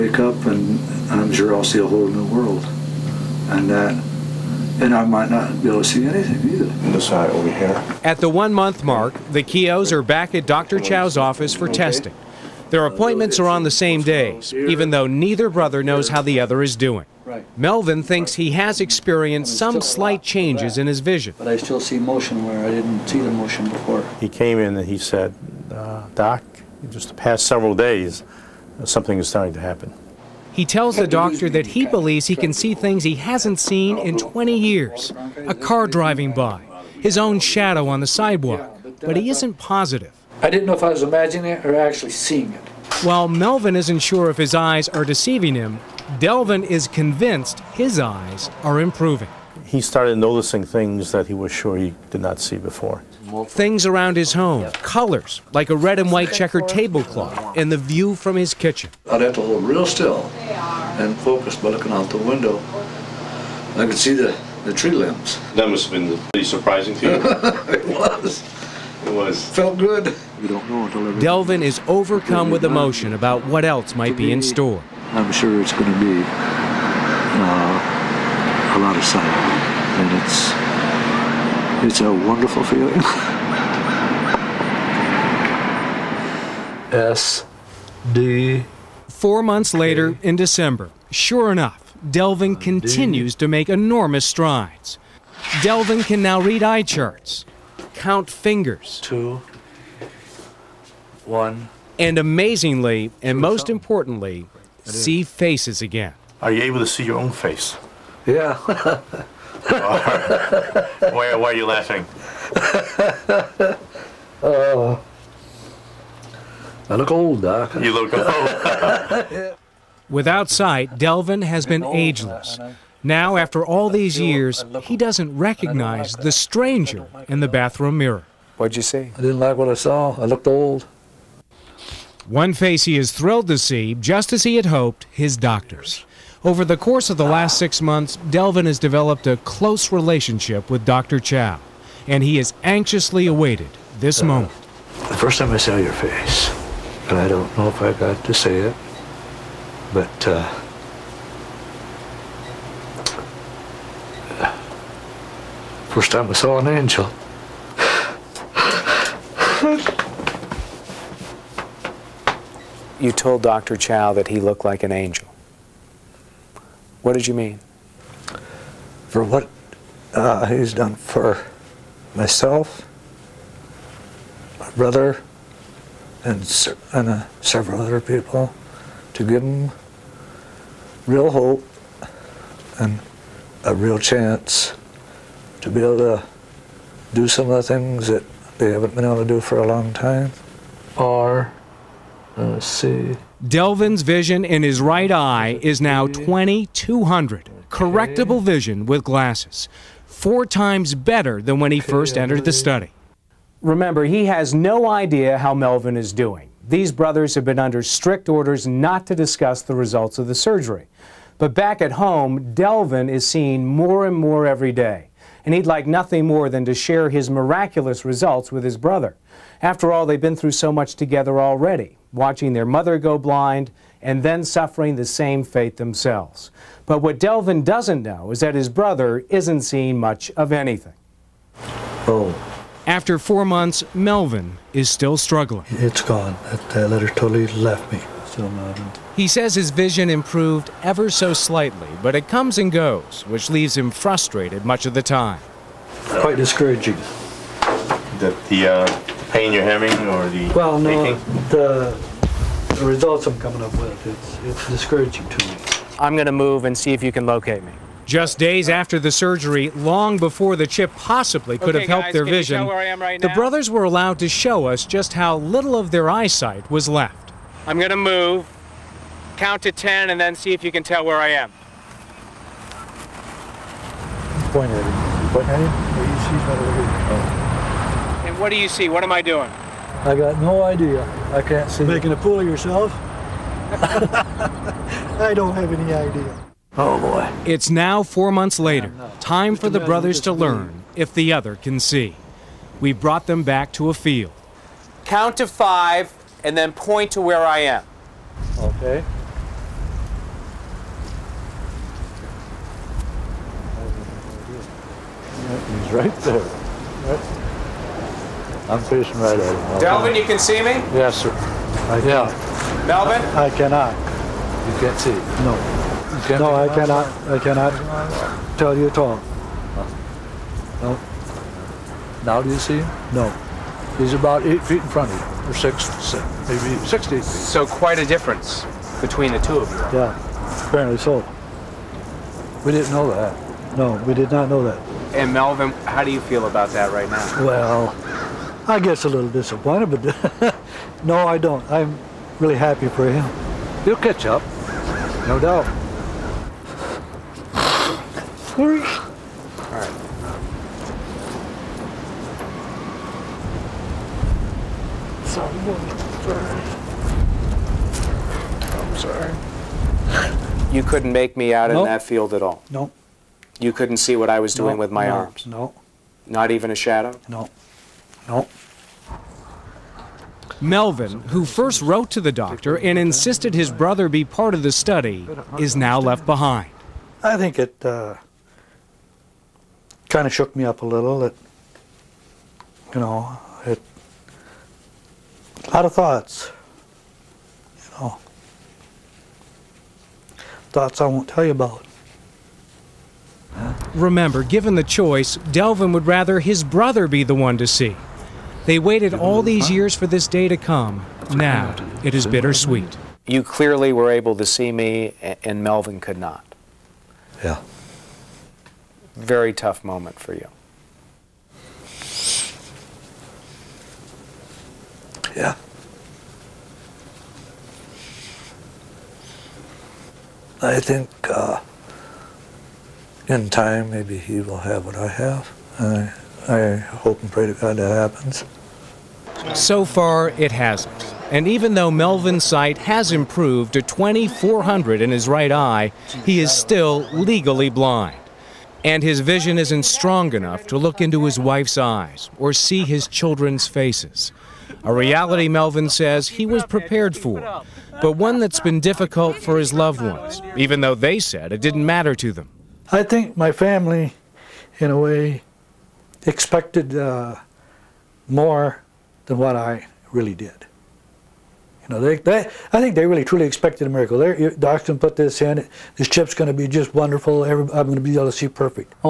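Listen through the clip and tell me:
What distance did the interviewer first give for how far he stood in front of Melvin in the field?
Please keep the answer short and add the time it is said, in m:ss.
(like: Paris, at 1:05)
8 feet, at 5:24.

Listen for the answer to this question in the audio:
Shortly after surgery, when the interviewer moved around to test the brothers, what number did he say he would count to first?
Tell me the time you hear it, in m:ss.
4:29.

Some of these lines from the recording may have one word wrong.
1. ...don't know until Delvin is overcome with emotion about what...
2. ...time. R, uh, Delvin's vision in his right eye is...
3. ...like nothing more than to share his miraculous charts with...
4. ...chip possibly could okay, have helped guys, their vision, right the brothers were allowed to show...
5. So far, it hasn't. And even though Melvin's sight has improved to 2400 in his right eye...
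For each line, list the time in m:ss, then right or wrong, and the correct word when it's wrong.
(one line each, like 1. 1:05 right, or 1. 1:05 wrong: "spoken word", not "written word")
1. 1:10 right
2. 3:09 right
3. 3:35 wrong: "results", not "charts"
4. 4:20 right
5. 7:09 right.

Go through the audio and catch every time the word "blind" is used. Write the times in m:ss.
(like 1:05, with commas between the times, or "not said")
3:43, 7:17.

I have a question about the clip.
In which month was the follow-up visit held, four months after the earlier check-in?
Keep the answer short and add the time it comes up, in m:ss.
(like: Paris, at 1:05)
December, at 1:30.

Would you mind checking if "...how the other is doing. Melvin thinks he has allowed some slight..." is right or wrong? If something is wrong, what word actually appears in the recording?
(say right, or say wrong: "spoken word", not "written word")
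wrong: "experienced", not "allowed".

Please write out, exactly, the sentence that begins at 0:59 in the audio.
I'd have to hold real still and focus by looking out the window.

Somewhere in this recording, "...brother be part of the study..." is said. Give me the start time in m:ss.
6:13.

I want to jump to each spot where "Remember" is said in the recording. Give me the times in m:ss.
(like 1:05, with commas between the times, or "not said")
3:23, 6:33.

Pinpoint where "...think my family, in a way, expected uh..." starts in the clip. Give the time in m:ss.
7:33.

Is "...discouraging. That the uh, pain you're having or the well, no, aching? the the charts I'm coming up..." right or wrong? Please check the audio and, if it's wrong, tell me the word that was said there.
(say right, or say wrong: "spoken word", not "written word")
wrong: "results", not "charts".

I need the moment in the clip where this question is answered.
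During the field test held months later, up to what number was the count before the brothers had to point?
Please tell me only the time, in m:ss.
4:55.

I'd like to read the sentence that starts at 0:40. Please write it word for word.
I didn't know if I was imagining it or actually seeing it.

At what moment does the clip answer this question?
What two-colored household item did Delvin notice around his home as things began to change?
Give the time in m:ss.
0:55.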